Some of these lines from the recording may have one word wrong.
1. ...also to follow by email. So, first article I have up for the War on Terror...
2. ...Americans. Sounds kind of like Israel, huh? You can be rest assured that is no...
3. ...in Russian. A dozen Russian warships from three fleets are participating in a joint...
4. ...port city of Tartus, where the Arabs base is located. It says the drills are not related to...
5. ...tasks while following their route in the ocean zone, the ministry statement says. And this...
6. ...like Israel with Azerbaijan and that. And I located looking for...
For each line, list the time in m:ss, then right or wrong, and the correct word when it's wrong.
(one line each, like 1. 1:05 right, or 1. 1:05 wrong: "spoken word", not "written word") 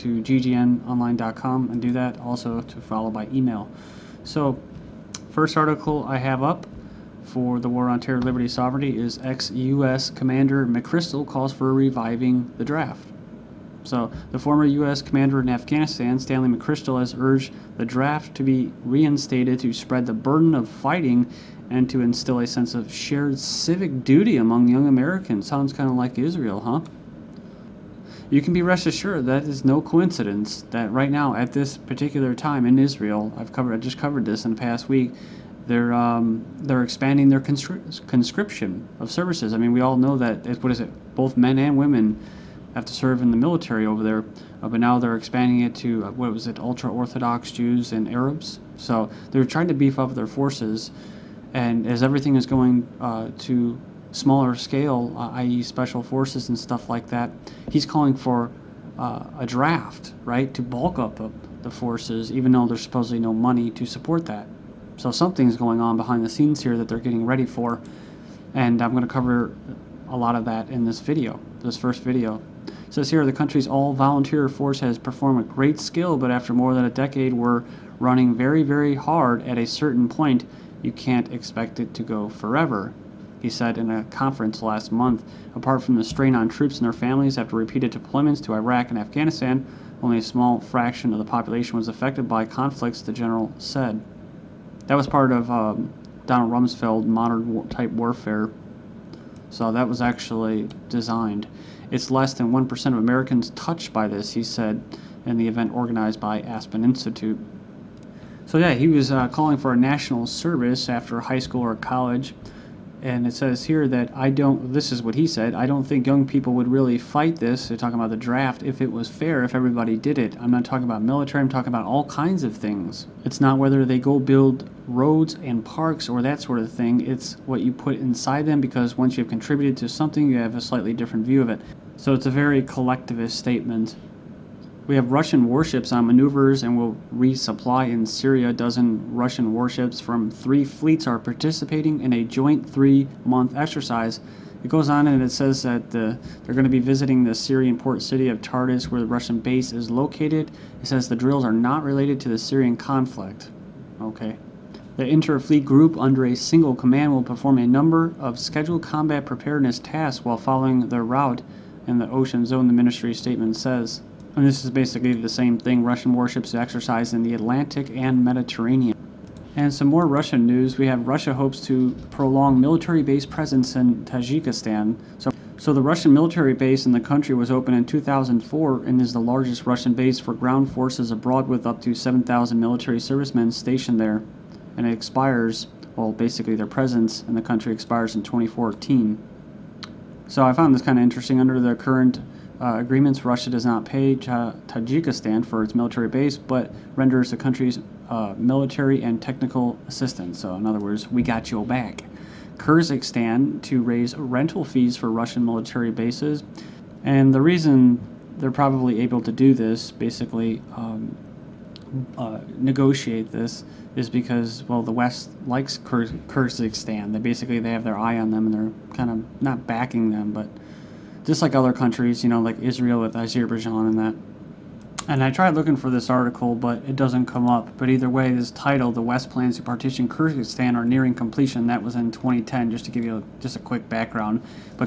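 1. 0:02 right
2. 0:24 right
3. 2:17 wrong: "Syria", not "Russian"
4. 2:27 wrong: "Russian", not "Arabs"
5. 2:39 right
6. 3:42 wrong: "tried", not "located".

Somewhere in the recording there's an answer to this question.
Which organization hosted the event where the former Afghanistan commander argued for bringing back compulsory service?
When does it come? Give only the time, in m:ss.
1:46.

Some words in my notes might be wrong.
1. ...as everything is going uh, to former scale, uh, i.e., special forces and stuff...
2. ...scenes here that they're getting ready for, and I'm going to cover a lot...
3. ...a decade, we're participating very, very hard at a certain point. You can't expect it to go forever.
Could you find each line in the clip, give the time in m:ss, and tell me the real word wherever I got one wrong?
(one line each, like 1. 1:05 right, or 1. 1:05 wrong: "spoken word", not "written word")
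1. 0:51 wrong: "smaller", not "former"
2. 1:06 right
3. 1:16 wrong: "running", not "participating".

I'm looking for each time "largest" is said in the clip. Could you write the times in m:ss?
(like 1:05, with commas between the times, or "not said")
2:59.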